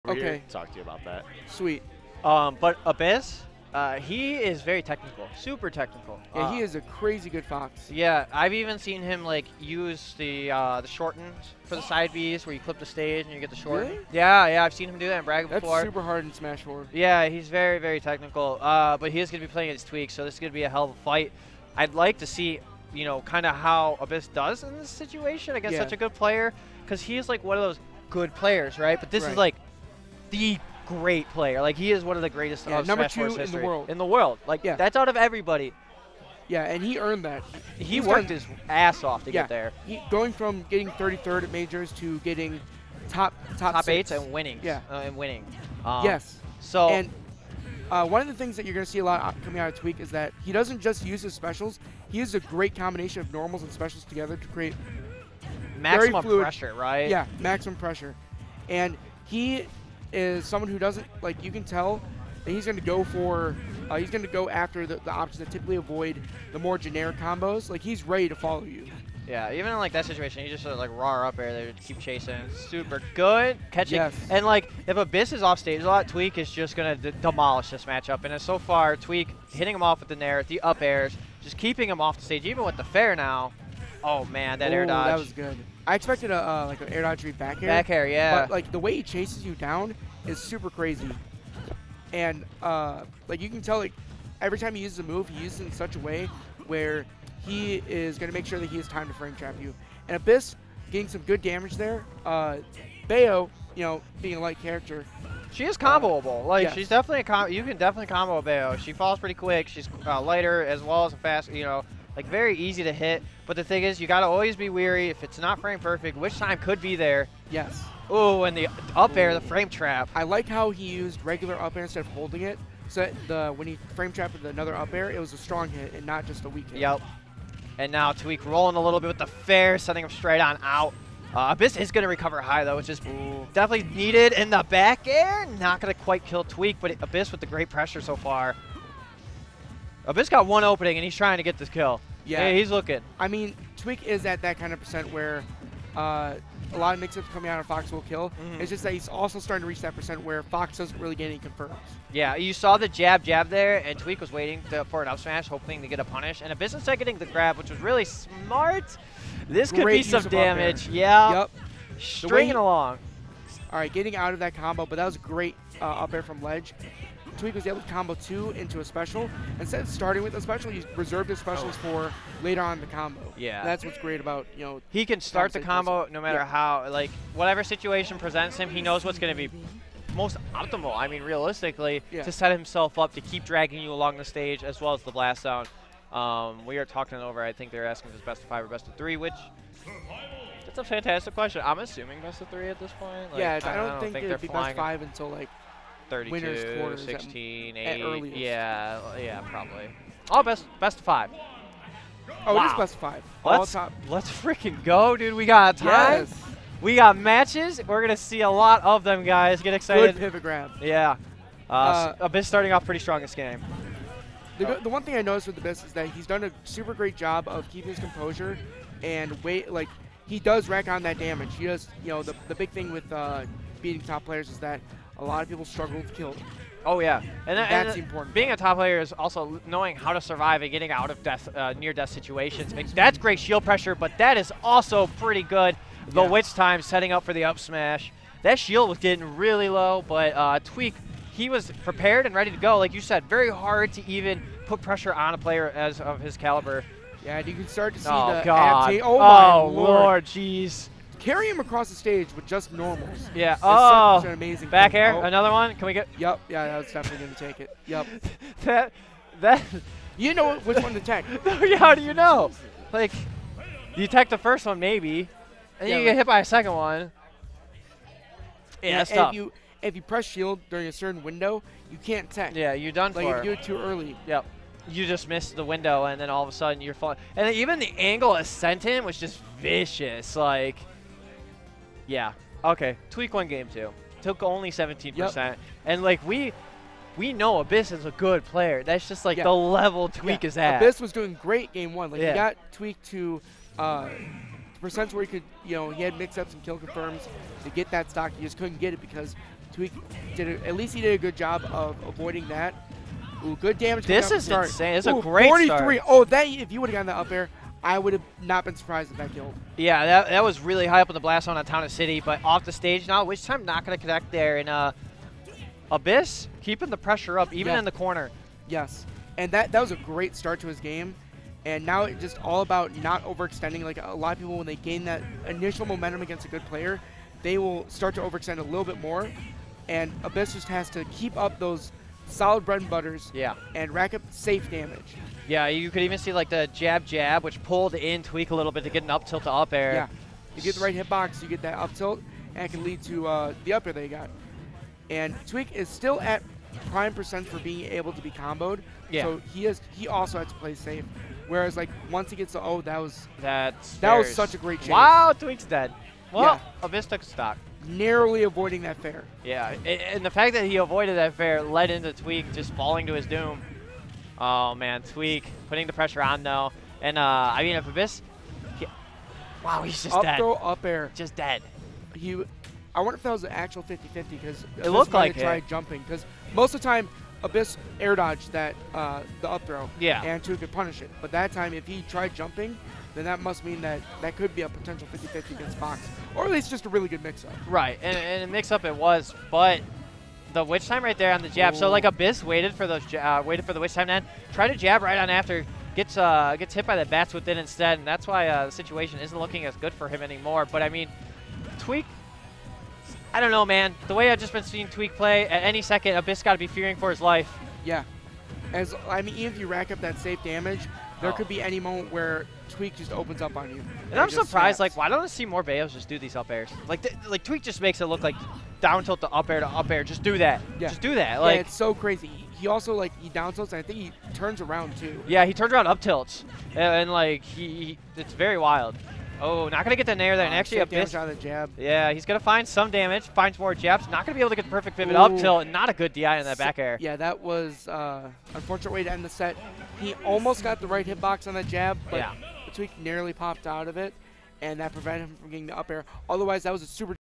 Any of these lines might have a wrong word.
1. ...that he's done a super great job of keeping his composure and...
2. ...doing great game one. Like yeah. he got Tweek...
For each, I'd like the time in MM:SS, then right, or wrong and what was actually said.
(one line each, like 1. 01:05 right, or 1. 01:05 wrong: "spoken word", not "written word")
1. 03:35 right
2. 04:51 right.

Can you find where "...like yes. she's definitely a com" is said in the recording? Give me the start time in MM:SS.
01:46.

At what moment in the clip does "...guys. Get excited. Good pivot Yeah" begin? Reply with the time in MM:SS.
03:29.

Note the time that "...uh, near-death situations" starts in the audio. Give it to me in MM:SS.
03:51.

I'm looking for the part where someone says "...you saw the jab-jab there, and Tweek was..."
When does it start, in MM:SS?
02:32.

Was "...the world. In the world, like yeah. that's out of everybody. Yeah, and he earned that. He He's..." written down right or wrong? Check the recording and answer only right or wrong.
right.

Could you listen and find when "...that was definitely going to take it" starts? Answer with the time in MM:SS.
04:16.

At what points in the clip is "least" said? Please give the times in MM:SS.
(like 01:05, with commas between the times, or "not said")
05:00, 06:26.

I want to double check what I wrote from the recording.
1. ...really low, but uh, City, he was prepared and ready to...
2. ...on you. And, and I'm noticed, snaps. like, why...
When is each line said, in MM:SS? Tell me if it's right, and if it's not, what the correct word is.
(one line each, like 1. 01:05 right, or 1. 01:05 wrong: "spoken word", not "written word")
1. 03:59 wrong: "Tweek", not "City"
2. 06:53 wrong: "surprised", not "noticed".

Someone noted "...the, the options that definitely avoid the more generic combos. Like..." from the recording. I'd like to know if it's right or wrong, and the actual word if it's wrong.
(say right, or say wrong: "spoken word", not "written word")
wrong: "typically", not "definitely".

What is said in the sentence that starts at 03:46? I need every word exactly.
Oh yeah, and, that's and important.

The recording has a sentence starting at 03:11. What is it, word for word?
I'm assuming best of three at this point.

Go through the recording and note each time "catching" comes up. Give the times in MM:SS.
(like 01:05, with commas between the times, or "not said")
01:13.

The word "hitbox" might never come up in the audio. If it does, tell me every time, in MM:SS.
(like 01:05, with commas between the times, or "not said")
05:40, 07:21.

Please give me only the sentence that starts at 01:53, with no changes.
But the thing is, you got to always be weary.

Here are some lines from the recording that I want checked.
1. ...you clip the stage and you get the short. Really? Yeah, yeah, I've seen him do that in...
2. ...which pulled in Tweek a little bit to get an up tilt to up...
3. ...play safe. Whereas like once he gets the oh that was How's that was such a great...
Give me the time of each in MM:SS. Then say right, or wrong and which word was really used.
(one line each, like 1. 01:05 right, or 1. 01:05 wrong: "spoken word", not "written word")
1. 00:12 right
2. 05:37 right
3. 05:50 wrong: "That", not "How".